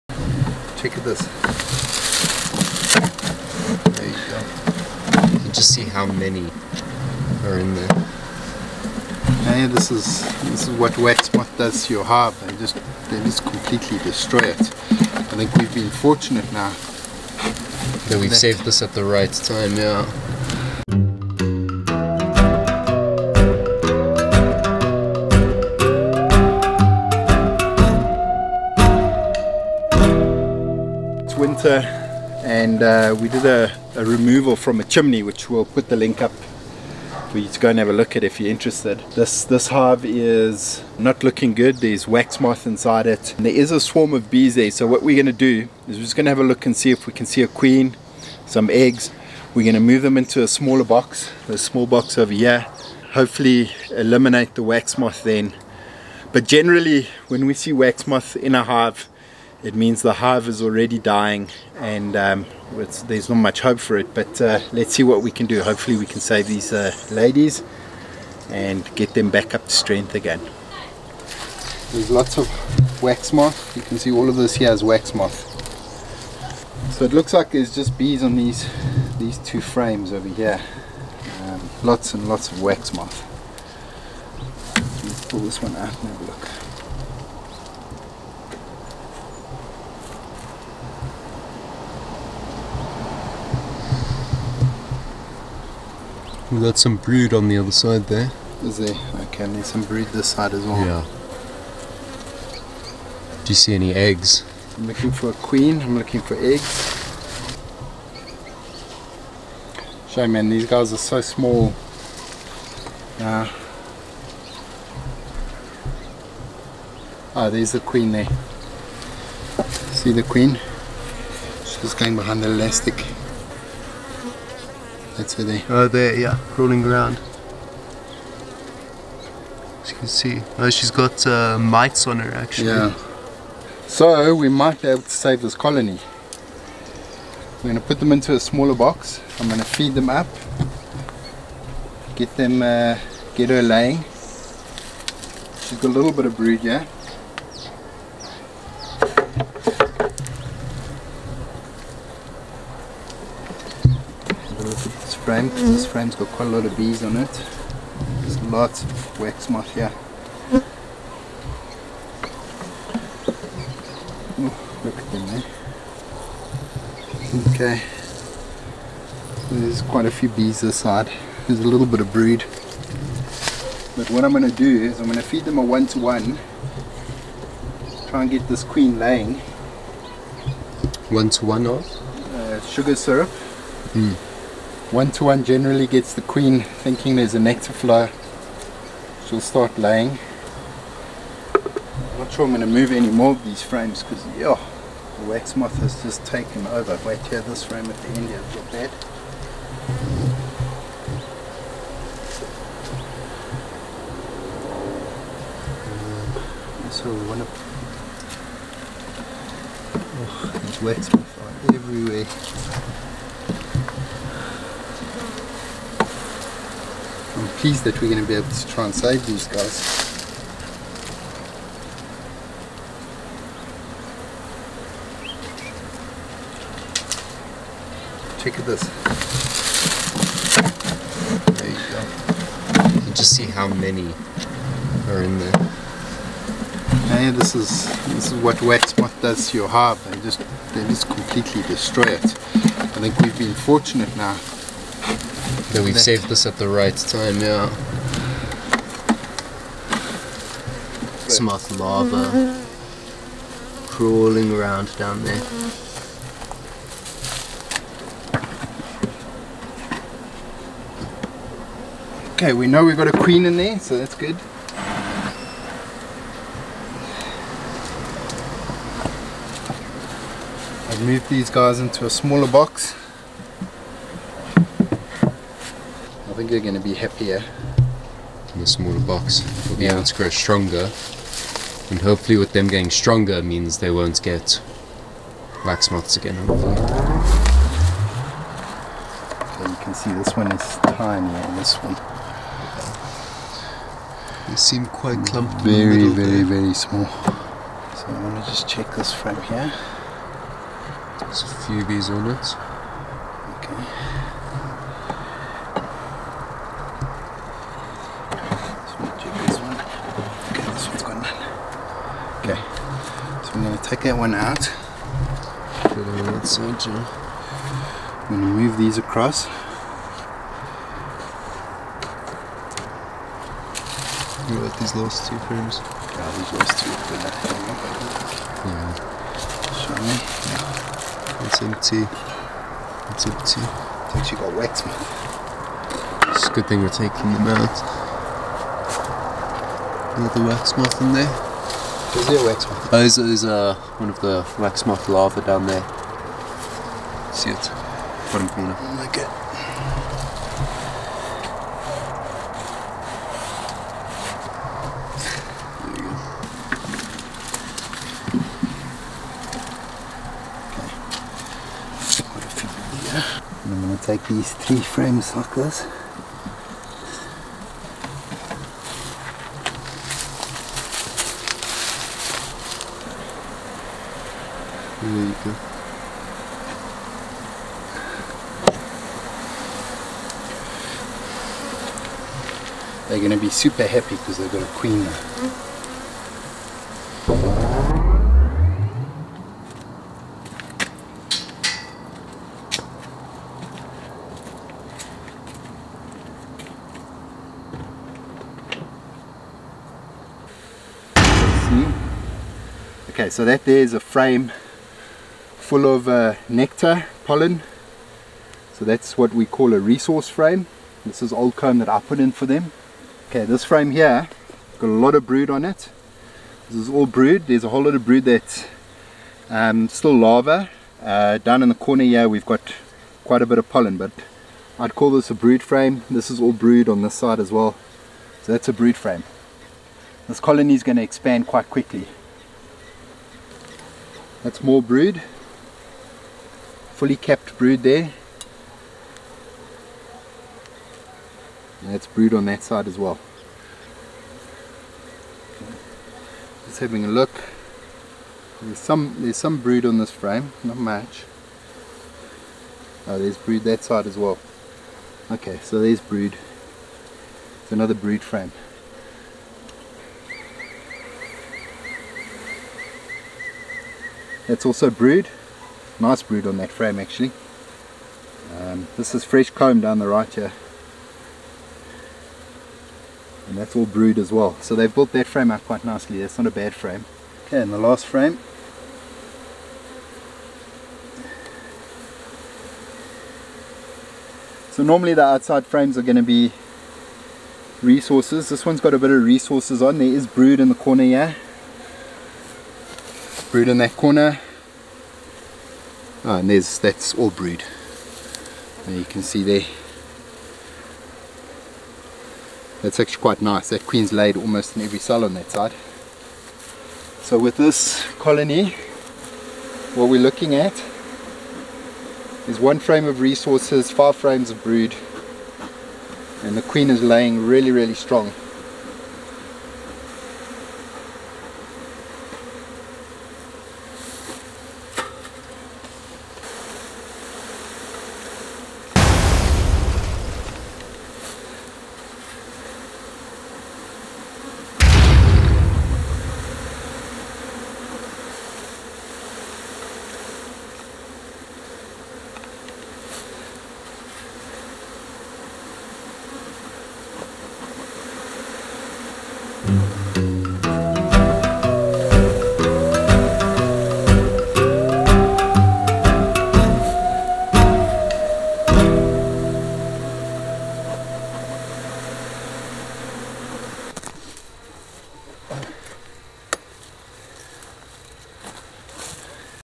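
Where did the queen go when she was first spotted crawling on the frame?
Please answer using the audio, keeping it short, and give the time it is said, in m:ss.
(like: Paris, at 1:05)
Behind the elastic, at 2:02.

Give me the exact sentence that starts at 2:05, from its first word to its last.
That's where they Oh there, yeah, crawling around.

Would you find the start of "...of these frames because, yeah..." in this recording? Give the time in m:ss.
3:13.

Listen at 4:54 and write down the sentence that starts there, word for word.
They seem quite clumped Very, very, there.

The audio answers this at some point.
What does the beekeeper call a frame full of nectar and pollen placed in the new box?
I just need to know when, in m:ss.
6:49.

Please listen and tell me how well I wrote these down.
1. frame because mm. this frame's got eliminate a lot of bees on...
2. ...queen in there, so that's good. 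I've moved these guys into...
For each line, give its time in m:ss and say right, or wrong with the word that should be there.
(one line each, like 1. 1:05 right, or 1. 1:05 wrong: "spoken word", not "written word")
1. 2:35 wrong: "quite", not "eliminate"
2. 4:23 right.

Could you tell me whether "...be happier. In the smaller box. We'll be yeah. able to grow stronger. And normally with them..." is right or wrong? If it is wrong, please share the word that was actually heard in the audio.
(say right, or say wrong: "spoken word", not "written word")
wrong: "hopefully", not "normally".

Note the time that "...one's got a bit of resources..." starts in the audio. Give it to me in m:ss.
8:08.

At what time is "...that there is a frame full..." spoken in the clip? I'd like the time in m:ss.
6:43.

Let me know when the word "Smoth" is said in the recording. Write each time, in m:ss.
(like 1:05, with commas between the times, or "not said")
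4:11.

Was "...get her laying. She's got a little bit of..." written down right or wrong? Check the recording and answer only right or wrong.
right.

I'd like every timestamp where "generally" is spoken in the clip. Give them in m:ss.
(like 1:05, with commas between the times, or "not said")
0:56, 3:05.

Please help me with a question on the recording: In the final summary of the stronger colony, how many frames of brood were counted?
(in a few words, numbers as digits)
5.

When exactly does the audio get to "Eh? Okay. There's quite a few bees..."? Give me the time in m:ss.
2:47.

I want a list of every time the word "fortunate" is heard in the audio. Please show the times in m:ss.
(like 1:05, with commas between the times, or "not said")
0:15, 4:03.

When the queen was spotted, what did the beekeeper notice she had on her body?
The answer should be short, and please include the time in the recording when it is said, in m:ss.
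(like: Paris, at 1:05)
Mites, at 2:11.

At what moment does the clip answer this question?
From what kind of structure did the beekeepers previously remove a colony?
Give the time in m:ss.
0:34.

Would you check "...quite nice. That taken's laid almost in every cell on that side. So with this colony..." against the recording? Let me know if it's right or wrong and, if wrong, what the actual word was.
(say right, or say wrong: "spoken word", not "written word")
wrong: "queen", not "taken".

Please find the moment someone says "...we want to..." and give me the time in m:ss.
3:27.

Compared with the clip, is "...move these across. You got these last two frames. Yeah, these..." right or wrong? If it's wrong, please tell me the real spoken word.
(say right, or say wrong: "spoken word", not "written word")
right.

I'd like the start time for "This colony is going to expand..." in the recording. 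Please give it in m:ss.
7:10.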